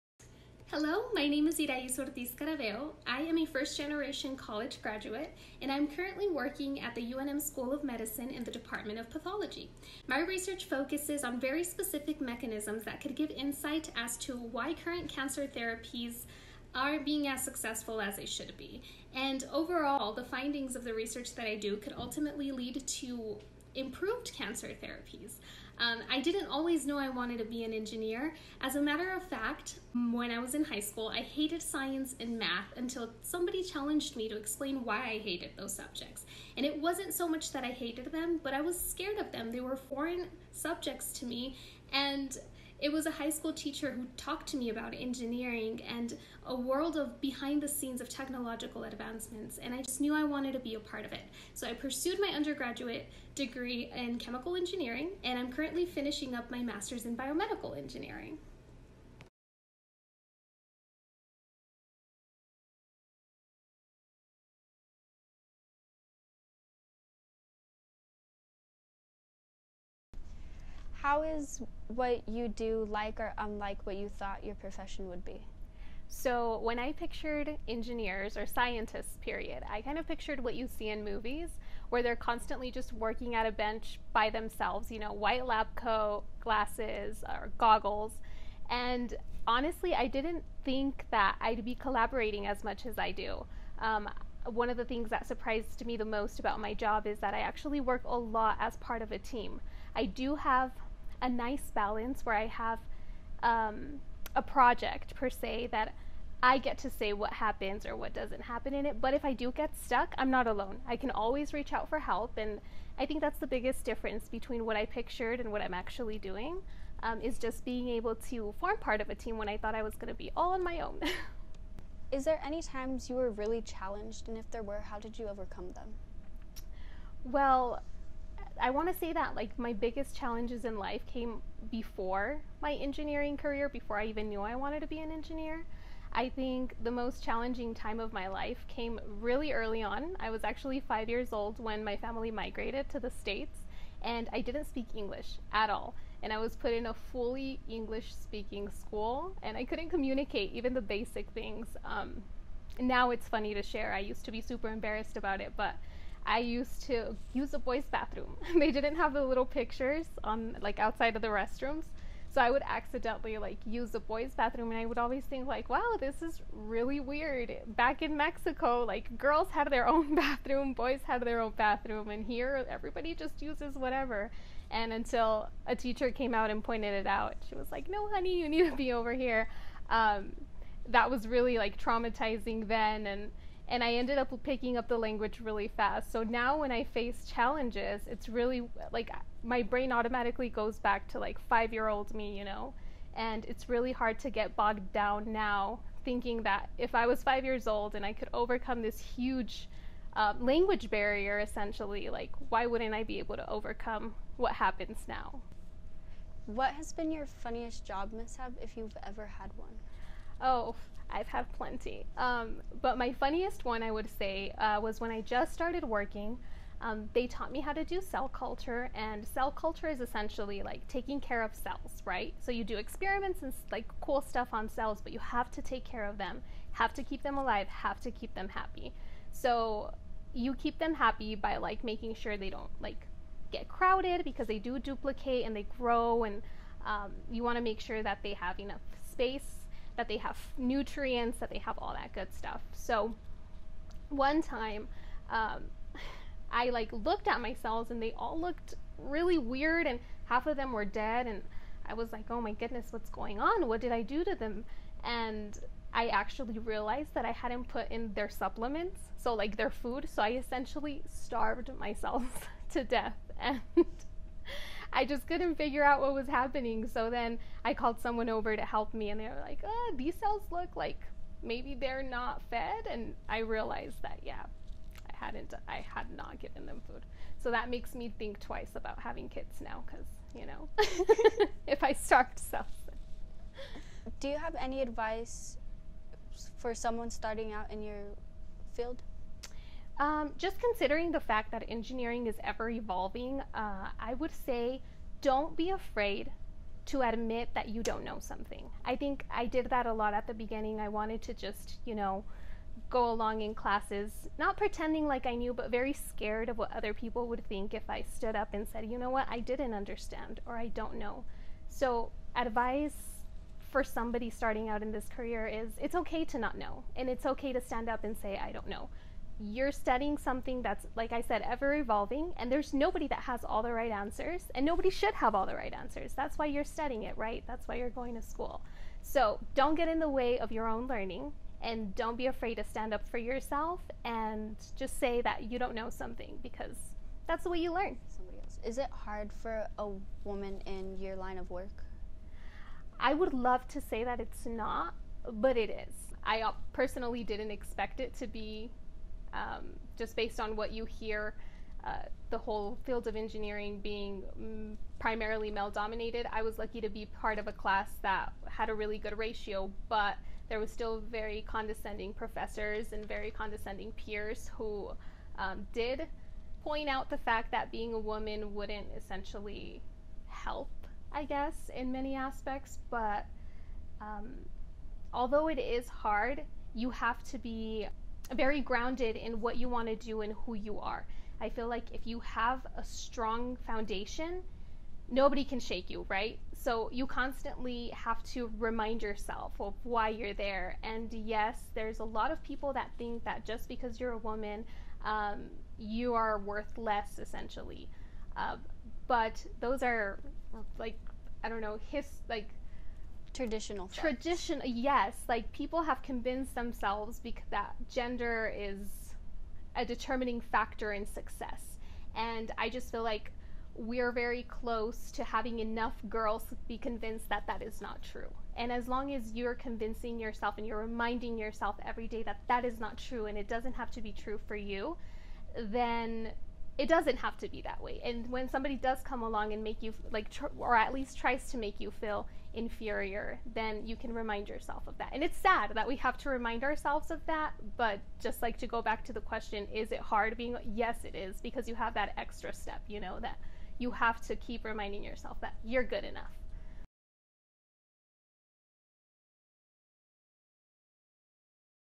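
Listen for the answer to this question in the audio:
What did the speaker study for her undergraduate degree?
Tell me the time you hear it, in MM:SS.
00:54.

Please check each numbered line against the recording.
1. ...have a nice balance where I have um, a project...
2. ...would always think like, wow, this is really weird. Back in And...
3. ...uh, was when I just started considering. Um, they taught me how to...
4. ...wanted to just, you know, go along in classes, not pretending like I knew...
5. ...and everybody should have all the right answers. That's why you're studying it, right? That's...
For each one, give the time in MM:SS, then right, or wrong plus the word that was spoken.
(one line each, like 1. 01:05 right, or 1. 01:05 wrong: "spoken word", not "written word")
1. 01:40 right
2. 02:44 wrong: "Mexico", not "And"
3. 03:34 wrong: "working", not "considering"
4. 05:00 right
5. 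05:24 wrong: "nobody", not "everybody".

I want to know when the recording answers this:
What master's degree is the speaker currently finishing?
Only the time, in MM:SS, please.
00:57.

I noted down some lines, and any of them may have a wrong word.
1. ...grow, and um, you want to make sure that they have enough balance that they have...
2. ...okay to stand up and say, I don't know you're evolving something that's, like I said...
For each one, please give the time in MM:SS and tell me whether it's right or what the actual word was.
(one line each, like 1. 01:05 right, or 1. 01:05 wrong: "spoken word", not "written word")
1. 03:55 wrong: "space", not "balance"
2. 05:17 wrong: "studying", not "evolving".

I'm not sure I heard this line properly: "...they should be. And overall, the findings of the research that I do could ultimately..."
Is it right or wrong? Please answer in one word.
right.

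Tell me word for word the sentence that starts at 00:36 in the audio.
And it wasn't so much that I hated them, but I was scared of them.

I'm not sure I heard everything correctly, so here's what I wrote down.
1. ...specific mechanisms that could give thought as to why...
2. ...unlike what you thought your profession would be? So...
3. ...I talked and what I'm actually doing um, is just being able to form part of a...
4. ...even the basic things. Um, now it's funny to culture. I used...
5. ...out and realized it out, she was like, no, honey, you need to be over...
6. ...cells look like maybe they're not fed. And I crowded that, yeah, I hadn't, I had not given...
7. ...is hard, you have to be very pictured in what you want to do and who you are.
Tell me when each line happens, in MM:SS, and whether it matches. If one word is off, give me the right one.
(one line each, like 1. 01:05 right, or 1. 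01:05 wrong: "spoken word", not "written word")
1. 00:11 wrong: "insight", not "thought"
2. 01:13 right
3. 01:54 wrong: "pictured", not "talked"
4. 02:30 wrong: "share", not "culture"
5. 02:56 wrong: "pointed", not "realized"
6. 04:30 wrong: "realized", not "crowded"
7. 06:15 wrong: "grounded", not "pictured".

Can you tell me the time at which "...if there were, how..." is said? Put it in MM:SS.
02:04.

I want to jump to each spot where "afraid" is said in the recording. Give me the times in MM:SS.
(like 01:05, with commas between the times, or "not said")
04:55, 05:32.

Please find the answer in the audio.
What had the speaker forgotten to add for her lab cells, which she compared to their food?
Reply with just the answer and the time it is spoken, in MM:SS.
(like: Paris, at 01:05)
Supplements, at 04:18.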